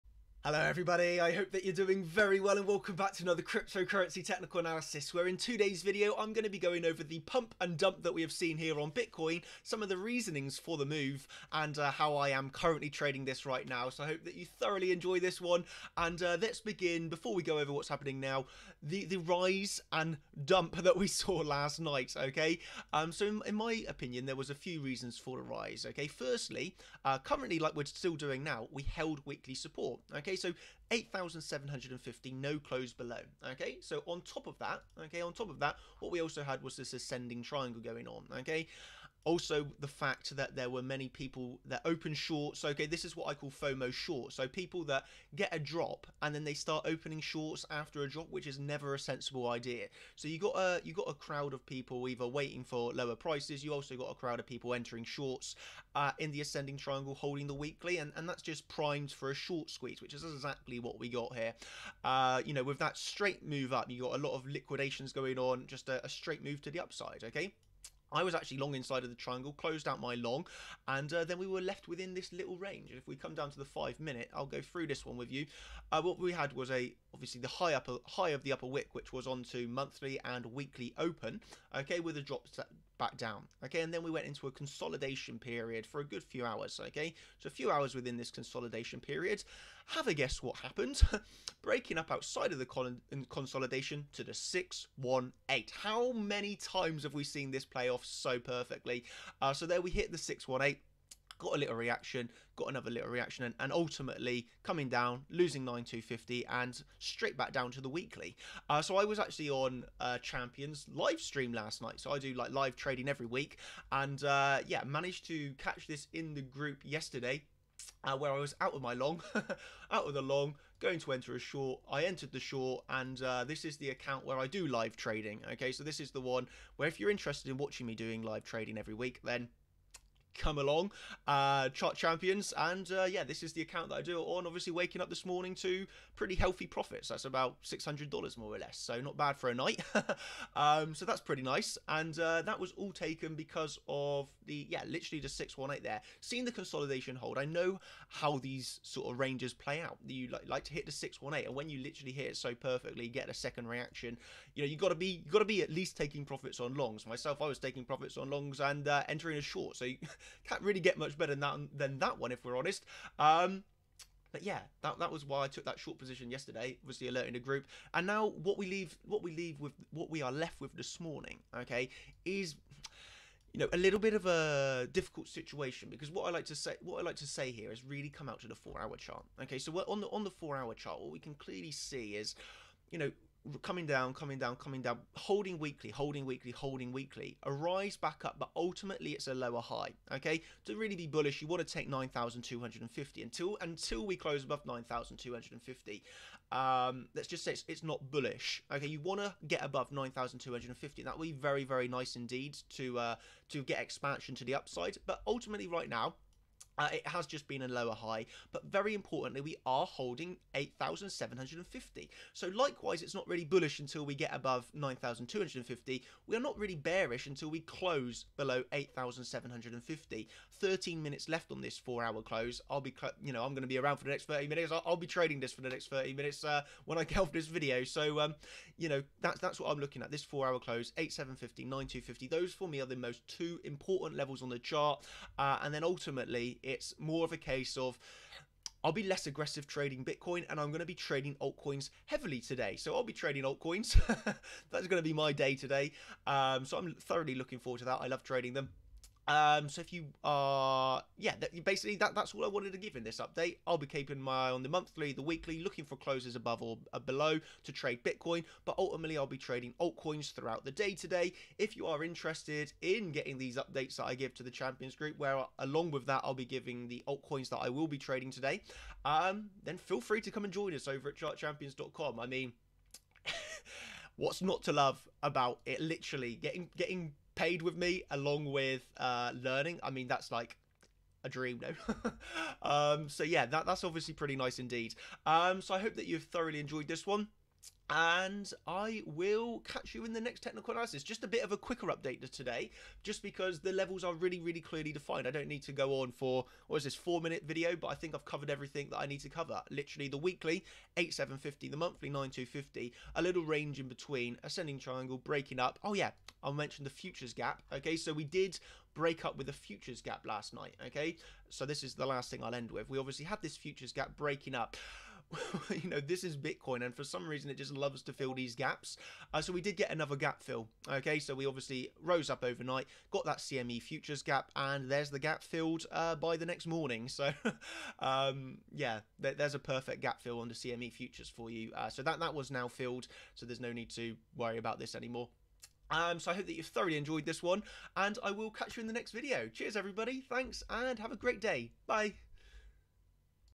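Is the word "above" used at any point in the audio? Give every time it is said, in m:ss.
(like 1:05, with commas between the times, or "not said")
3:14, 3:19, 3:34, 4:16.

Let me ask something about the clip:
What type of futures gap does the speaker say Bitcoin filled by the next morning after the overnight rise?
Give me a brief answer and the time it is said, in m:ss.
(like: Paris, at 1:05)
CME futures gap, at 5:23.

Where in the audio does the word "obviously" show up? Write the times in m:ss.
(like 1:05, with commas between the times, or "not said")
1:17, 2:14, 4:43, 5:12, 5:21.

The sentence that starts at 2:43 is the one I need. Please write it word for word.
Um, but yeah, that, that was why I took that short position yesterday, Was the alert in the group.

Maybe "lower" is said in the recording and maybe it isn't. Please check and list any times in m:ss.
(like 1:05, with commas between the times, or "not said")
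0:52, 3:09, 3:27.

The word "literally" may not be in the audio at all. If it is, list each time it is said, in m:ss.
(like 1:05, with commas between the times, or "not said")
2:24, 2:31, 4:35, 4:59.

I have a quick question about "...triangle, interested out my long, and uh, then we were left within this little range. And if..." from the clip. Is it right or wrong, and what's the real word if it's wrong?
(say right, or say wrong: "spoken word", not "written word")
wrong: "closed", not "interested".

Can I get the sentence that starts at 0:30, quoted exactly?
Okay, so 8,750, no close below.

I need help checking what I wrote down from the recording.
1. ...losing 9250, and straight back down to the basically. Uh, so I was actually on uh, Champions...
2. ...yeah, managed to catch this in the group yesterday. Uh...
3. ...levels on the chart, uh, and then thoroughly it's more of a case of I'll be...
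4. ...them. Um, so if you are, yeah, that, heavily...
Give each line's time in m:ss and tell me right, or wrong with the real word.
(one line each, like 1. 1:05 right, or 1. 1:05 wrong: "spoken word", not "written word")
1. 1:45 wrong: "weekly", not "basically"
2. 1:54 right
3. 3:54 wrong: "ultimately", not "thoroughly"
4. 4:08 wrong: "basically", not "heavily".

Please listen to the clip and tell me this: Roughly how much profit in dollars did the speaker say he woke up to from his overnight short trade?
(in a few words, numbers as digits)
600 dollars.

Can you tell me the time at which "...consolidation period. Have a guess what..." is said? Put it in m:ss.
1:28.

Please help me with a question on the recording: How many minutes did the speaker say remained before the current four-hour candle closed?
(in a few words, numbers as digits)
13.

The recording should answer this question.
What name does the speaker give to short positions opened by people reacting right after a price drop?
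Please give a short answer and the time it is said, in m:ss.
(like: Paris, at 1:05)
FOMO shorts, at 0:43.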